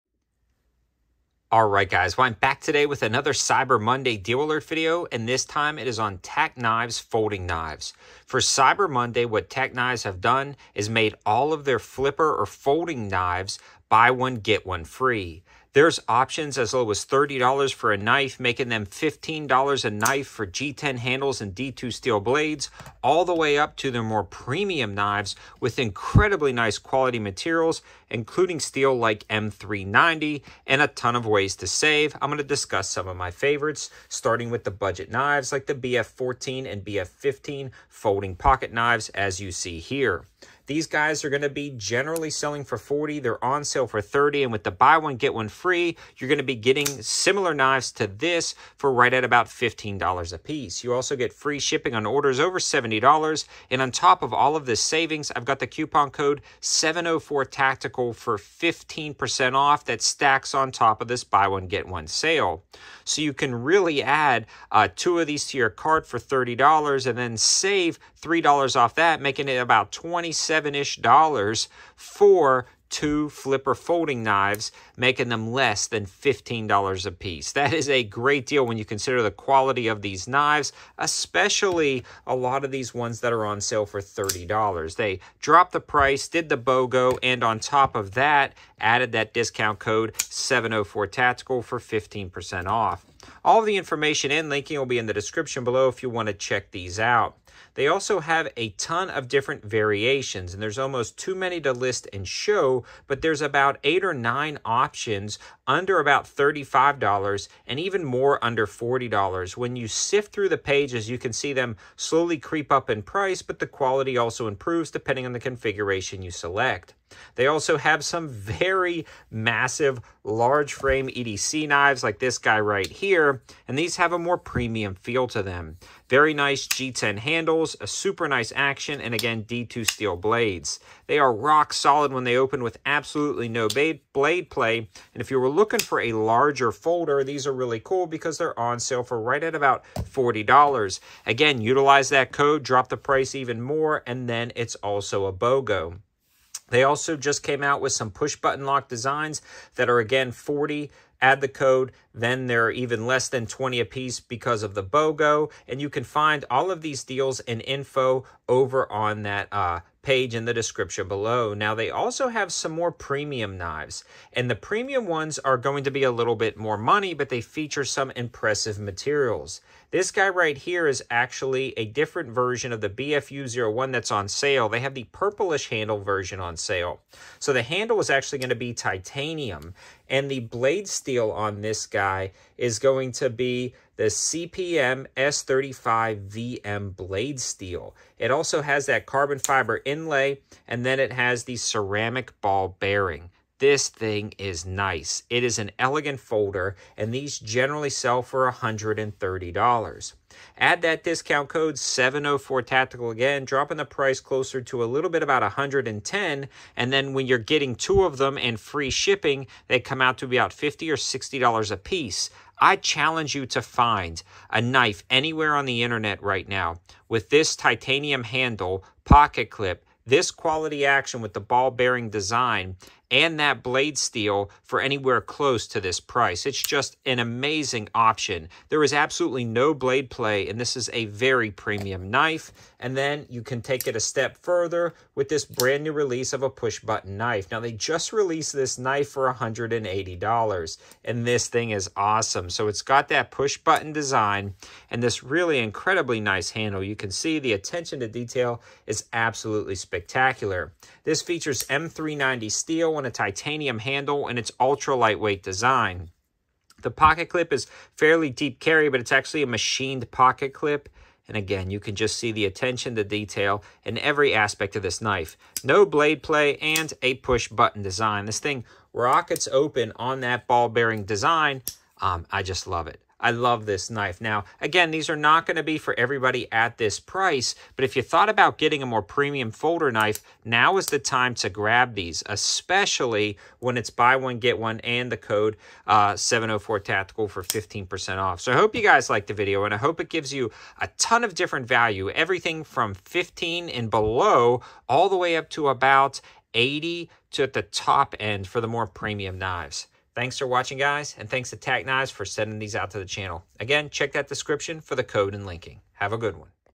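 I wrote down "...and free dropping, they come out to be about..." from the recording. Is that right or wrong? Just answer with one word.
wrong.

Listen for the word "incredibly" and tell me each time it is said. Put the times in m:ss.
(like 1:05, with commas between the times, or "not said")
0:25, 4:05.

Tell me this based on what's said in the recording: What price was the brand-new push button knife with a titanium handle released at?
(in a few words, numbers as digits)
$180.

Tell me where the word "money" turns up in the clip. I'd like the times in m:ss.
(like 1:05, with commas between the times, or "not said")
2:46.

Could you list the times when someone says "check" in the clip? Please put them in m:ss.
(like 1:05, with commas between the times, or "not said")
1:36, 5:03.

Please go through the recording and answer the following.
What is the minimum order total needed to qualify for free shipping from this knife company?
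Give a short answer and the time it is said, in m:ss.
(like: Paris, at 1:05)
$70, at 0:52.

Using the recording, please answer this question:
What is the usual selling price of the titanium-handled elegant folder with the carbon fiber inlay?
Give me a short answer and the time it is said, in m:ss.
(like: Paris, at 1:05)
$130, at 3:18.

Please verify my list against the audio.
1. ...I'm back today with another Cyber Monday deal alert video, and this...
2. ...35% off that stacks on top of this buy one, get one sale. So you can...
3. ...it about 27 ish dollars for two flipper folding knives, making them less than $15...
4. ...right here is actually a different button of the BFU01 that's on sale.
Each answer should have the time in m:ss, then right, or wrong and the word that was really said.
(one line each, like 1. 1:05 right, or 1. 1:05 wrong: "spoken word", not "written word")
1. 0:02 right
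2. 0:58 wrong: "15", not "35"
3. 1:09 right
4. 2:50 wrong: "version", not "button".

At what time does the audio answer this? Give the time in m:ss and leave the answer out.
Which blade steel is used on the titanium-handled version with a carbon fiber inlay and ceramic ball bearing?
3:04.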